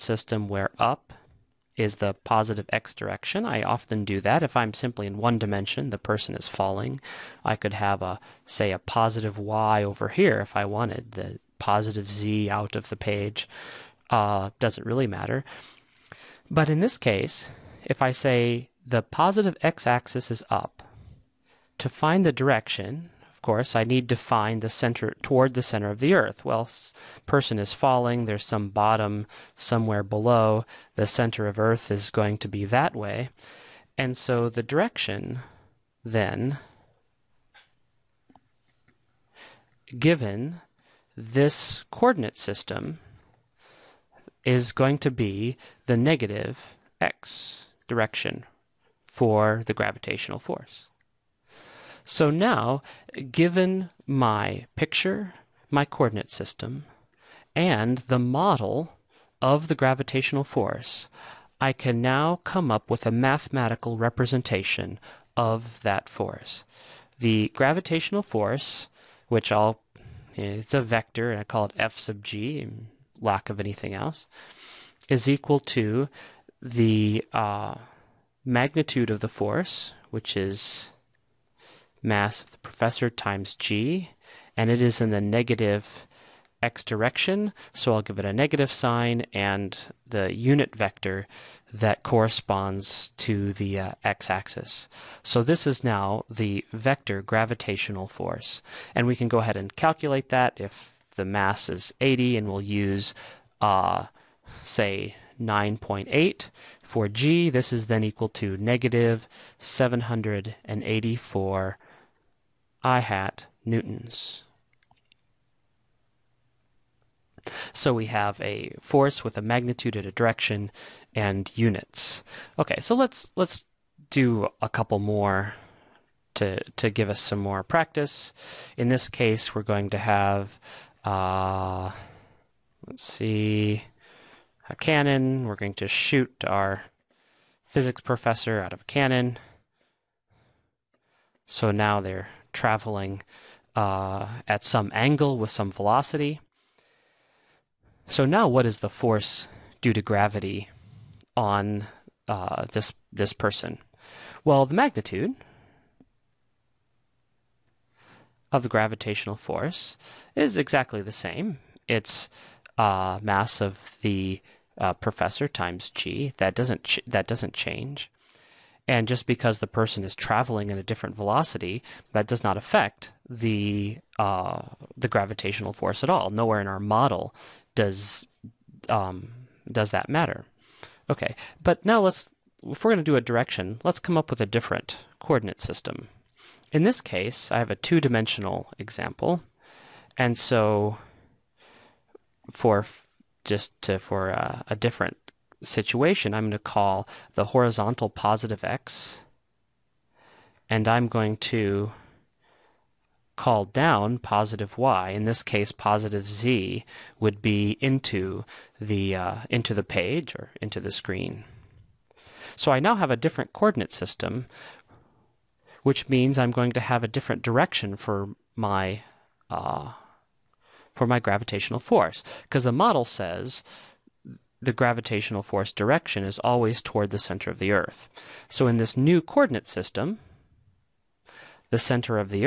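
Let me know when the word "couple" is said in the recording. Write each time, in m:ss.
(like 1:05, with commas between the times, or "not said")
2:04.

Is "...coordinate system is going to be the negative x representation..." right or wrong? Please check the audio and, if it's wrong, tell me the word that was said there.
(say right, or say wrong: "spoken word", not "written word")
wrong: "direction", not "representation".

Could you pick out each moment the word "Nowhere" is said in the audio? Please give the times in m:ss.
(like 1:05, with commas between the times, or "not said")
2:56.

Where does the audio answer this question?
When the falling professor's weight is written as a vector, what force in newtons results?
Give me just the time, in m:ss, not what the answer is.
1:48.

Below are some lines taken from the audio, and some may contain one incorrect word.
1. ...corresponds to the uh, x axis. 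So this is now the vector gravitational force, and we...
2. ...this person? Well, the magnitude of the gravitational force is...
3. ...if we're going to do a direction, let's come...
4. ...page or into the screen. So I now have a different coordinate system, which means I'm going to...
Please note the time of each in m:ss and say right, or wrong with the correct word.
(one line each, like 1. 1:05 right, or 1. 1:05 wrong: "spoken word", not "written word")
1. 1:32 right
2. 2:33 right
3. 3:02 right
4. 3:29 right.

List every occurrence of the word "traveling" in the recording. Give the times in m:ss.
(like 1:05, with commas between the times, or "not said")
2:22, 2:50.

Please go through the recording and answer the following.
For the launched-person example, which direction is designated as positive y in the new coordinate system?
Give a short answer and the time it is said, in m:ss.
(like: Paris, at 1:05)
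down, at 3:23.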